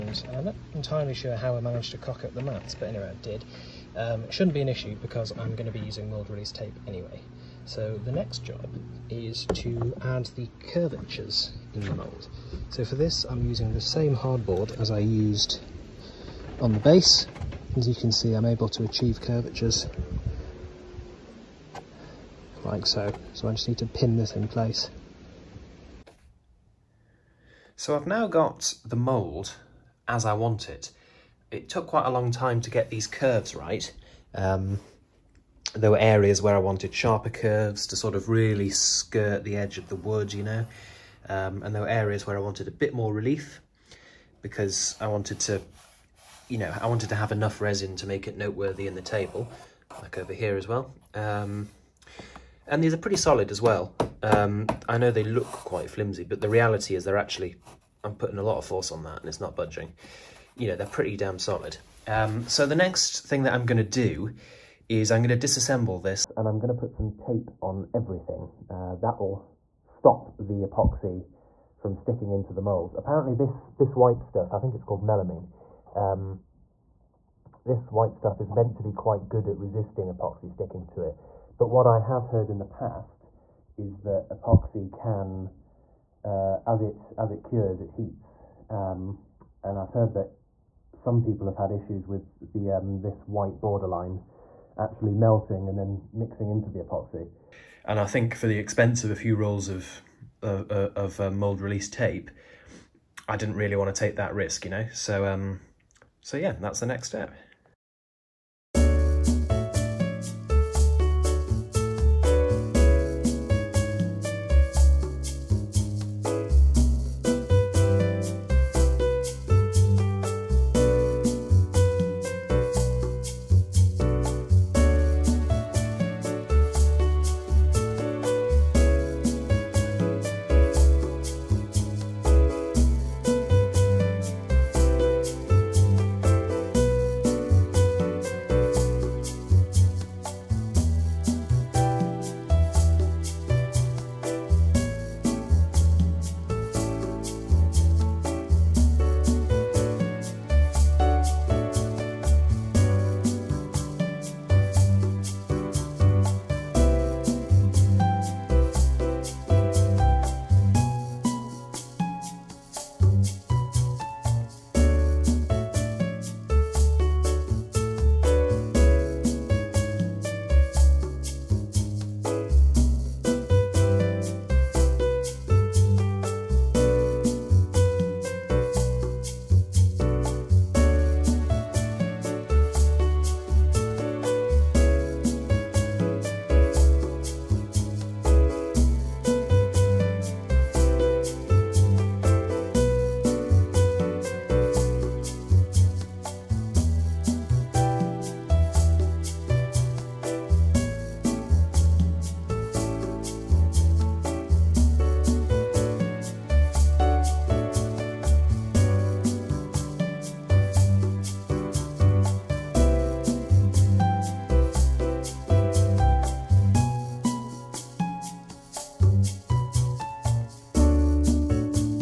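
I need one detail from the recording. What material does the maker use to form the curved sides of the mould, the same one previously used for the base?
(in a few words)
Hardboard.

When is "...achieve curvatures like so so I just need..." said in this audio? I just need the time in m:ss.
0:18.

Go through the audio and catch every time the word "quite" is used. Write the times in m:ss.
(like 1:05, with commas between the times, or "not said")
0:31, 0:55, 1:18.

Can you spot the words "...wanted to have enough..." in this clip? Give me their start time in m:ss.
0:46.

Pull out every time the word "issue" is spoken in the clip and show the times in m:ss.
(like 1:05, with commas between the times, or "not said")
0:04, 1:31.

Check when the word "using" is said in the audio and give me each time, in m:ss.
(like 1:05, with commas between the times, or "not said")
0:05, 0:13.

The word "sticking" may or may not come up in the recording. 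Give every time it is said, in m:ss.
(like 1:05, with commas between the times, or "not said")
1:11, 1:20.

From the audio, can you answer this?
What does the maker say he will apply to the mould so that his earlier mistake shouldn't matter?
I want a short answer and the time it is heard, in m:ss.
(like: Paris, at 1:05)
Mould release tape, at 0:06.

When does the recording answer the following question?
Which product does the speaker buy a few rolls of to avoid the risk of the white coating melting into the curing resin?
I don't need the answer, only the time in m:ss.
1:41.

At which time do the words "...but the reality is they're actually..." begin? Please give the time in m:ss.
0:56.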